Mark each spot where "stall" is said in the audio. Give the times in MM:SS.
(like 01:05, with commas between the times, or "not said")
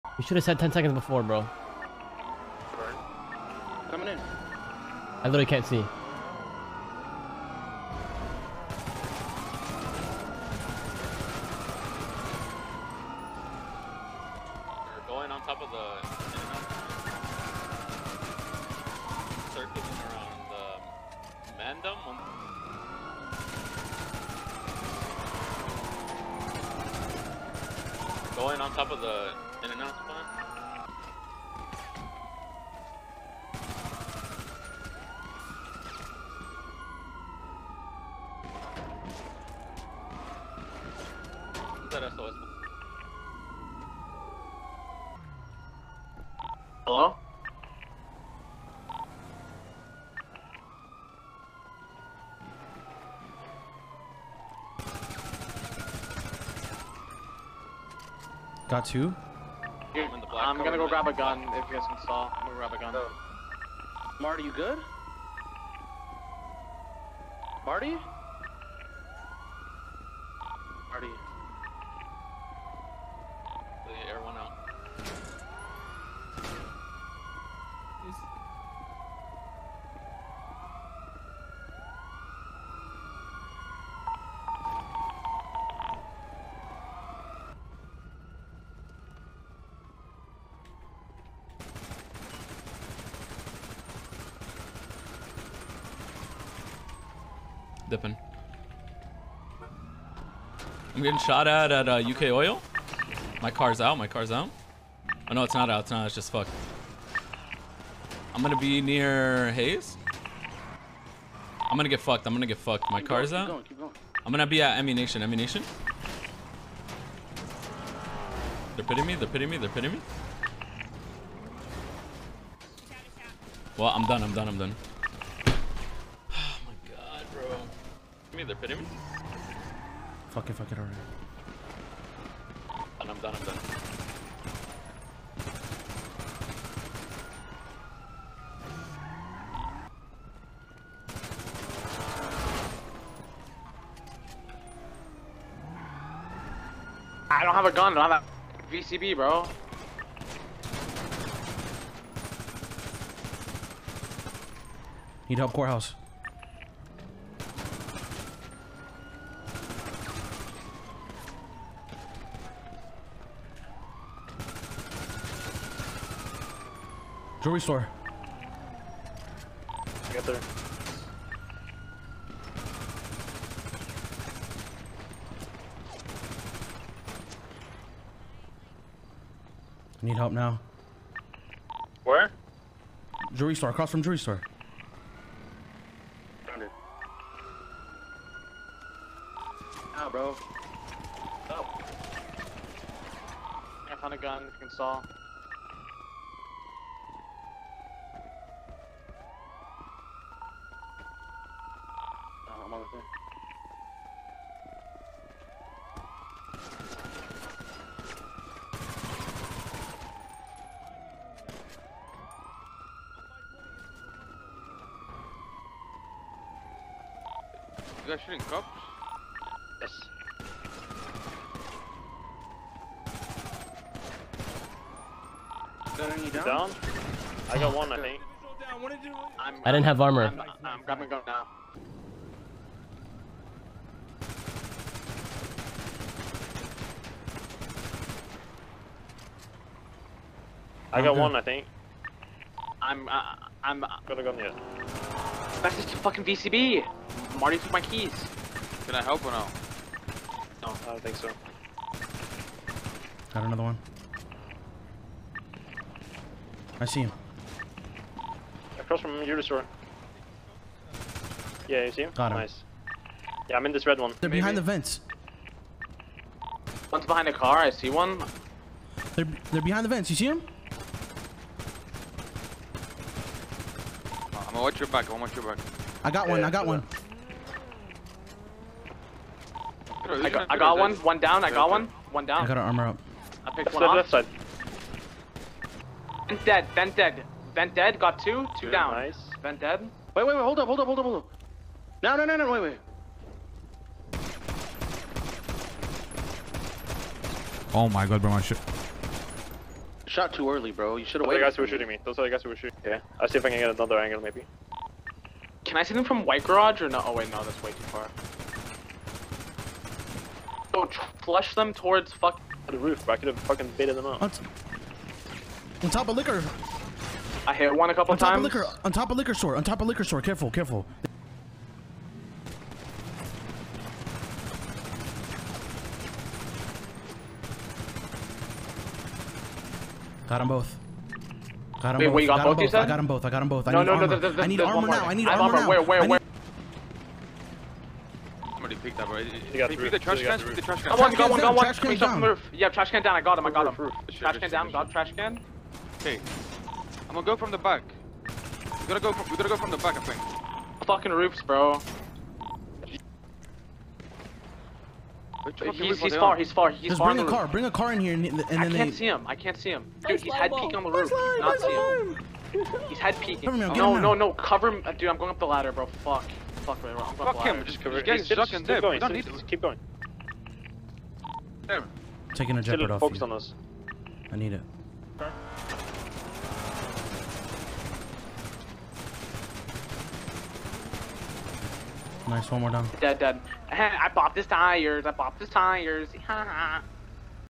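01:02.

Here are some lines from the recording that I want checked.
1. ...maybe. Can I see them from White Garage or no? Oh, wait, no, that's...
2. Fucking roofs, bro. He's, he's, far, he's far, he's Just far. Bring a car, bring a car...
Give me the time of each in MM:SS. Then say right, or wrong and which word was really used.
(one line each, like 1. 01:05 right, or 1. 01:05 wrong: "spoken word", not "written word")
1. 05:04 right
2. 05:50 right.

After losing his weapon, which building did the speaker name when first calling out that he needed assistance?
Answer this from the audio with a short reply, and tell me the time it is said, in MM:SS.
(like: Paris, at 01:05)
Courthouse, at 02:35.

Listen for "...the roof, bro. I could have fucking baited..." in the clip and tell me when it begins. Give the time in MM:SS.
05:12.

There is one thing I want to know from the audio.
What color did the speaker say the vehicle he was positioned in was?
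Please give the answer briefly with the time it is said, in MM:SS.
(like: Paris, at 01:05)
Red, at 04:23.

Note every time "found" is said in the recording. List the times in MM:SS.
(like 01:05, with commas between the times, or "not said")
03:06, 03:13.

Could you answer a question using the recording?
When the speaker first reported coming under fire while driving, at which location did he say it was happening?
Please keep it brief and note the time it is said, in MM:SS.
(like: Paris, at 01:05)
UK Oil, at 01:42.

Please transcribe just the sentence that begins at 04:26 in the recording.
One's behind the car, I see one.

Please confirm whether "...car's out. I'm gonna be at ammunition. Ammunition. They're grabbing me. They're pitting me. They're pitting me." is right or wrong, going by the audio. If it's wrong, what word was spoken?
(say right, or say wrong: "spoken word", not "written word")
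wrong: "pitting", not "grabbing".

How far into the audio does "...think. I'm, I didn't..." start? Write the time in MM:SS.
03:47.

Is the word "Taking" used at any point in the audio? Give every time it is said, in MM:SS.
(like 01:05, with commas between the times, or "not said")
06:12.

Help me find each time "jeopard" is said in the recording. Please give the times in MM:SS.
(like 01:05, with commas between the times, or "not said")
06:12.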